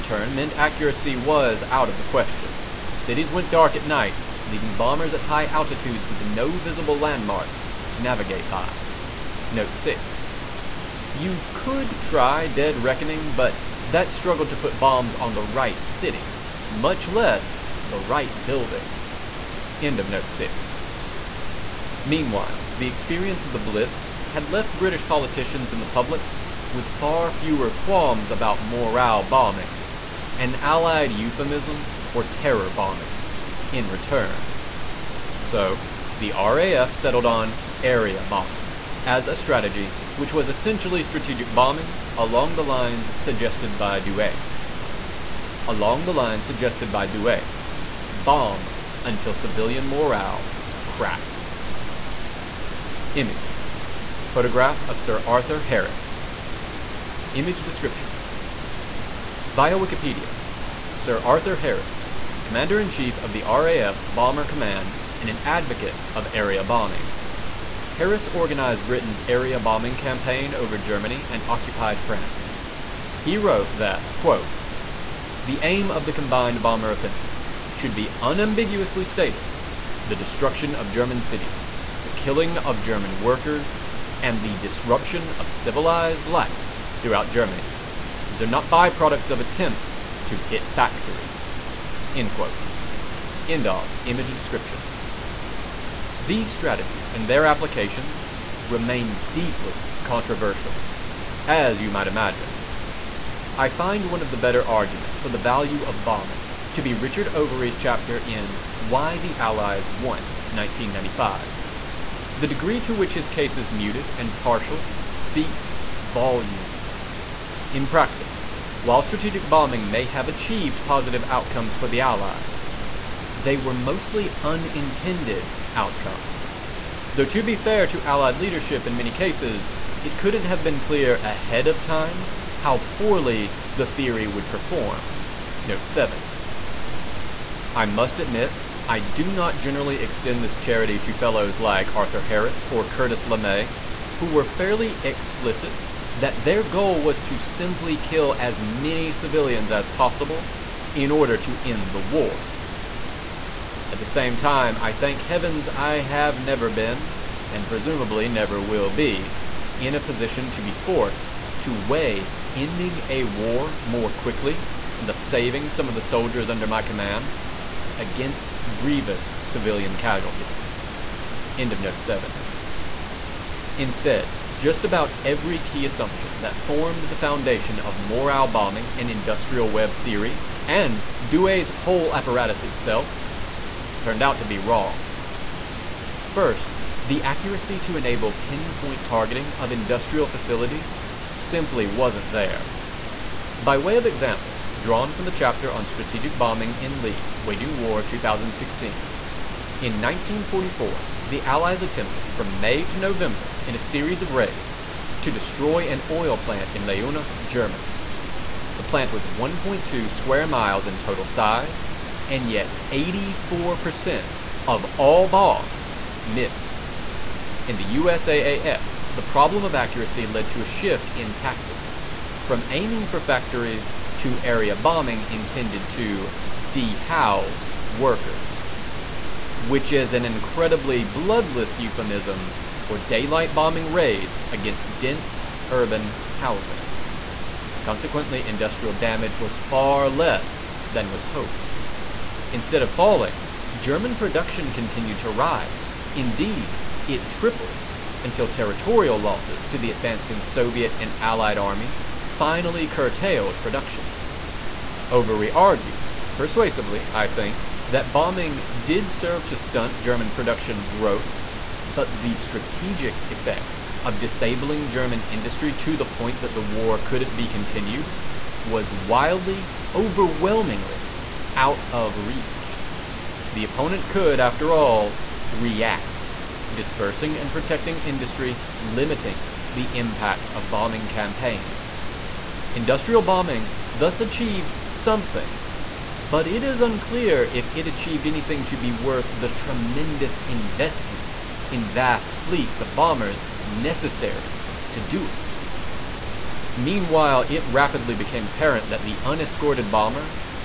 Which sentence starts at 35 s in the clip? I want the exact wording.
So, the RAF settled on area bombing as a strategy, which was essentially strategic bombing along the lines suggested by Douhet.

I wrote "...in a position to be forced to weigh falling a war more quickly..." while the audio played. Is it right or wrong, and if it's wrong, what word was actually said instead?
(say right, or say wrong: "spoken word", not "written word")
wrong: "ending", not "falling".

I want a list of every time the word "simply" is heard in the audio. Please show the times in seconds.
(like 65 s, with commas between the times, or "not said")
147 s, 191 s.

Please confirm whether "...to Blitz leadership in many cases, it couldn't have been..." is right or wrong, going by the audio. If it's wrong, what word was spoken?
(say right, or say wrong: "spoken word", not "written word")
wrong: "Allied", not "Blitz".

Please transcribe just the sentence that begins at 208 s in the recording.
The plant was 1.2 square miles in total size and yet 84% of all bombs missed.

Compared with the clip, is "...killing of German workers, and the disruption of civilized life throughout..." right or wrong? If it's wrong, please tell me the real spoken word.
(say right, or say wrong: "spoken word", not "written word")
right.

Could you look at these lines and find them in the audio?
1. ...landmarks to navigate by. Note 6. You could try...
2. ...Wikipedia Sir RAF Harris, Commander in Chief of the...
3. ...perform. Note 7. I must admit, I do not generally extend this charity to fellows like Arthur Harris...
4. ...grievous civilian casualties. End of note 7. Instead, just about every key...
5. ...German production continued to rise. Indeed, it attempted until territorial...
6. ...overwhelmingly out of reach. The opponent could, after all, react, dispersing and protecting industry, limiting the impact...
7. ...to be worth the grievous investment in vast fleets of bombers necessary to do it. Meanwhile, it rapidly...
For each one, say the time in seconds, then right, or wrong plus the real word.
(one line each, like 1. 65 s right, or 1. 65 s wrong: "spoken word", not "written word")
1. 6 s right
2. 59 s wrong: "Arthur", not "RAF"
3. 134 s right
4. 168 s right
5. 243 s wrong: "tripled", not "attempted"
6. 269 s right
7. 288 s wrong: "tremendous", not "grievous".